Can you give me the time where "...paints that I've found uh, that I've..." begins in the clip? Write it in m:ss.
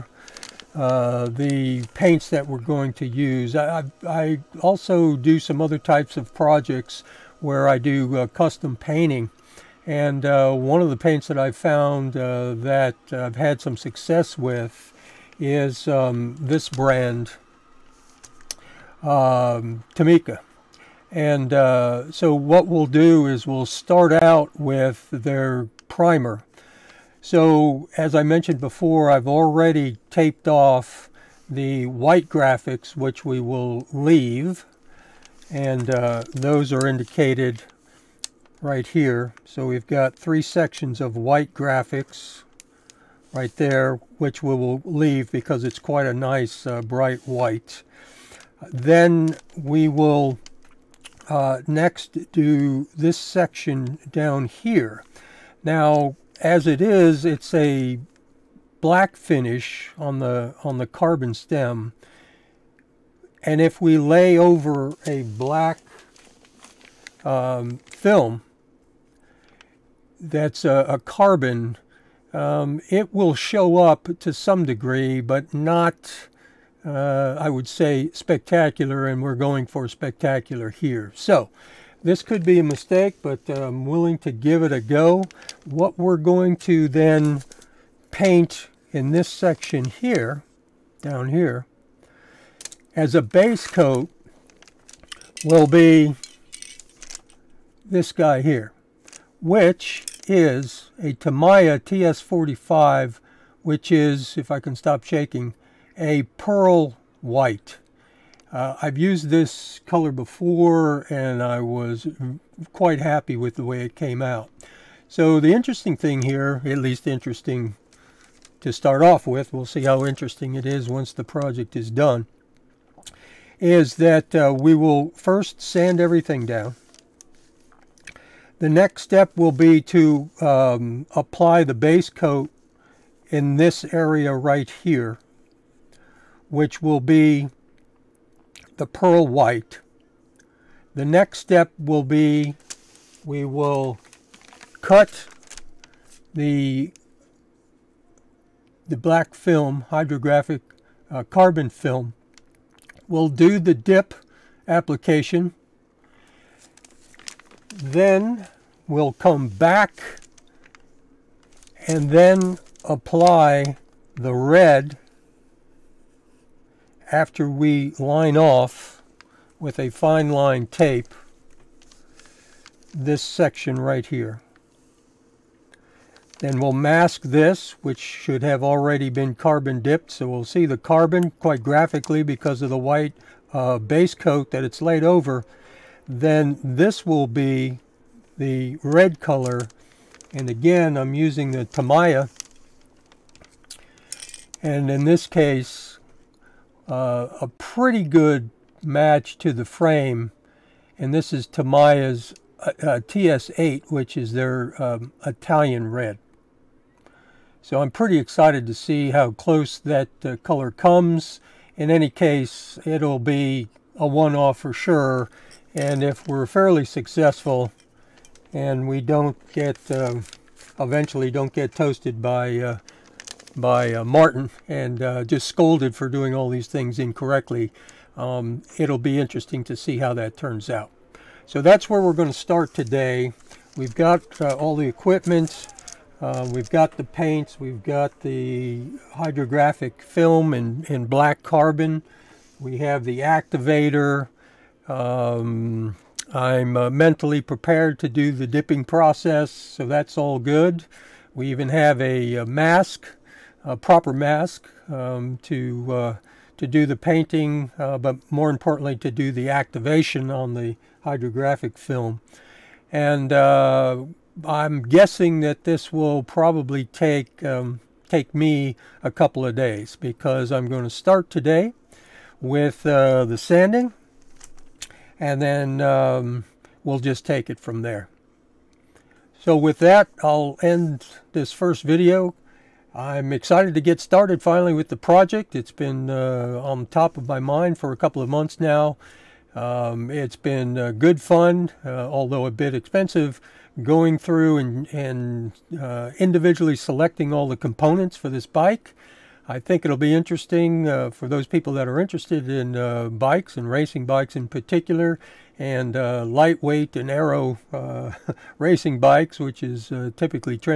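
0:10.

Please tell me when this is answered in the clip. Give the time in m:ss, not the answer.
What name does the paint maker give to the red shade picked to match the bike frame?
3:25.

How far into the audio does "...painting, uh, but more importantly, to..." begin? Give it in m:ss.
4:16.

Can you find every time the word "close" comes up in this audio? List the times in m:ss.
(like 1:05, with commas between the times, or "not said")
3:29.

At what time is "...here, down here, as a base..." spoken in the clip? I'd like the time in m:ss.
1:29.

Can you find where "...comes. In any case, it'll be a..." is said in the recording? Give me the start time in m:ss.
3:30.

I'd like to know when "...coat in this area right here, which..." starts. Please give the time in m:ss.
2:12.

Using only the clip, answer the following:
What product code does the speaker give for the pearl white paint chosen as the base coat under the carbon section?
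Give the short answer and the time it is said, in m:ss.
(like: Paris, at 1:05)
TS45, at 1:41.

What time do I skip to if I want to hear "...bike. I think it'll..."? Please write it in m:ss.
4:58.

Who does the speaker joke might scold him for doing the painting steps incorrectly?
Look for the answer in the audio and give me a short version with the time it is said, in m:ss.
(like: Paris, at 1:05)
Martin, at 3:44.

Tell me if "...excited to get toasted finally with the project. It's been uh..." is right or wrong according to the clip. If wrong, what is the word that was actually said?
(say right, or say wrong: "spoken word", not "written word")
wrong: "started", not "toasted".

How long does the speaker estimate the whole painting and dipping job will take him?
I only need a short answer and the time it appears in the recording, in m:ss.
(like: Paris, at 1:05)
a couple of days, at 4:29.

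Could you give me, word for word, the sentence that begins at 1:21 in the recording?
So this could be a mistake, but I'm willing to give it a go.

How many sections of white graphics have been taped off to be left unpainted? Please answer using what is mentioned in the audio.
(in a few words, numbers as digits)
3.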